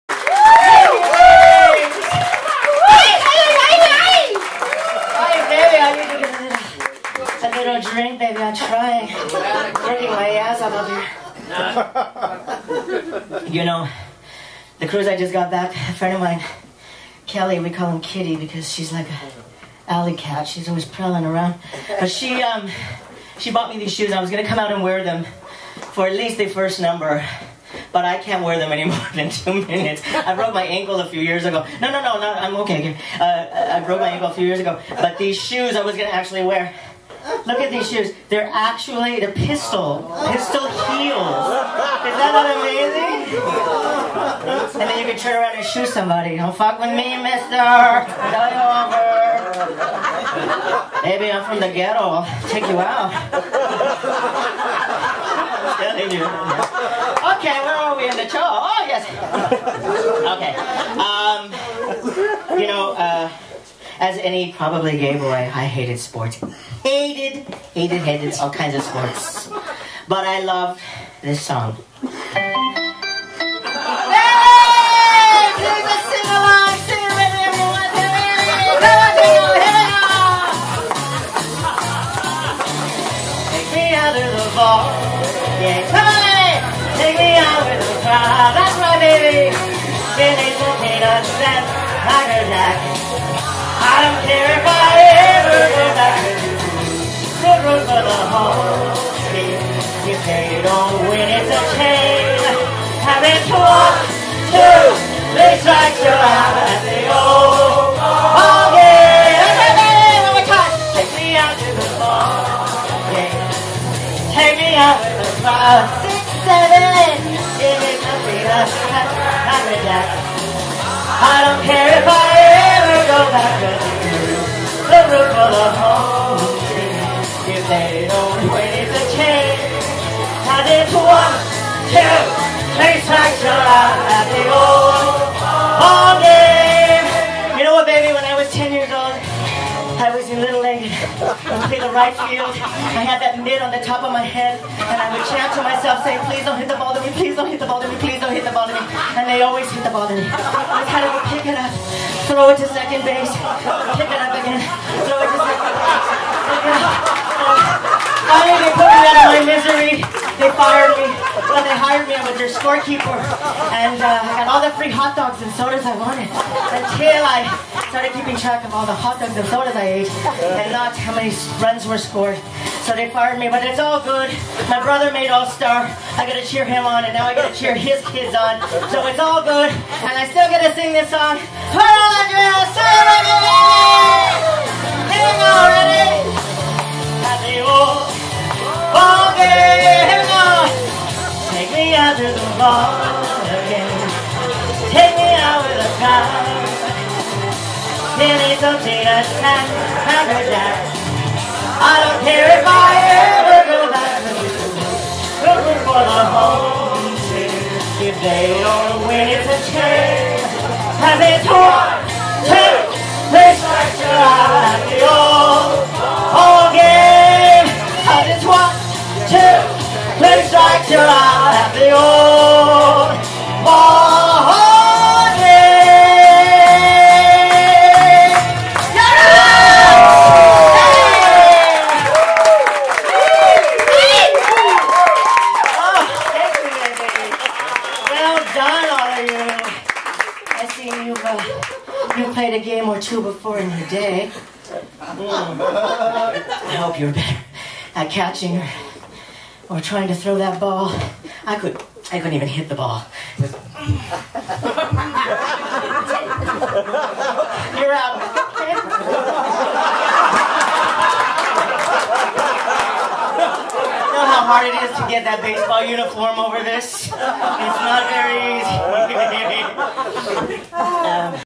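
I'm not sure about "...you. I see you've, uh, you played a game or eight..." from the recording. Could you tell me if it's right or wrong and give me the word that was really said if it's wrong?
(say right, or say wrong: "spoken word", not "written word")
wrong: "two", not "eight".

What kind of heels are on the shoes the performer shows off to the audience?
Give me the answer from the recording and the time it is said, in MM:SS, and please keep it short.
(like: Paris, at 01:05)
Pistol heels, at 00:40.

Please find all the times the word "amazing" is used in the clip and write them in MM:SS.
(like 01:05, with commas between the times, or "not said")
00:42.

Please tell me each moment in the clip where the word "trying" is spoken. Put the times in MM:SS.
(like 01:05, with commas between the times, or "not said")
00:08, 04:09.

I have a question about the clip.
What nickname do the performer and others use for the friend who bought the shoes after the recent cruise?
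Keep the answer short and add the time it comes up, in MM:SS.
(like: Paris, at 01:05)
Kitty, at 00:18.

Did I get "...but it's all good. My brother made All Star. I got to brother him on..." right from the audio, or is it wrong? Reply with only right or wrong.
wrong.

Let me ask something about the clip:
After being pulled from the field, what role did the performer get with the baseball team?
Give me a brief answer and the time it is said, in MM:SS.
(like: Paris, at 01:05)
Scorekeeper, at 02:42.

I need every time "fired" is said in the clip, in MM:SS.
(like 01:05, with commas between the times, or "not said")
02:40, 02:53.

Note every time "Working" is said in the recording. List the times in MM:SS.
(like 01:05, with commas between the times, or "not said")
00:09.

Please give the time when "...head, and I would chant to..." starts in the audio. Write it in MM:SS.
02:24.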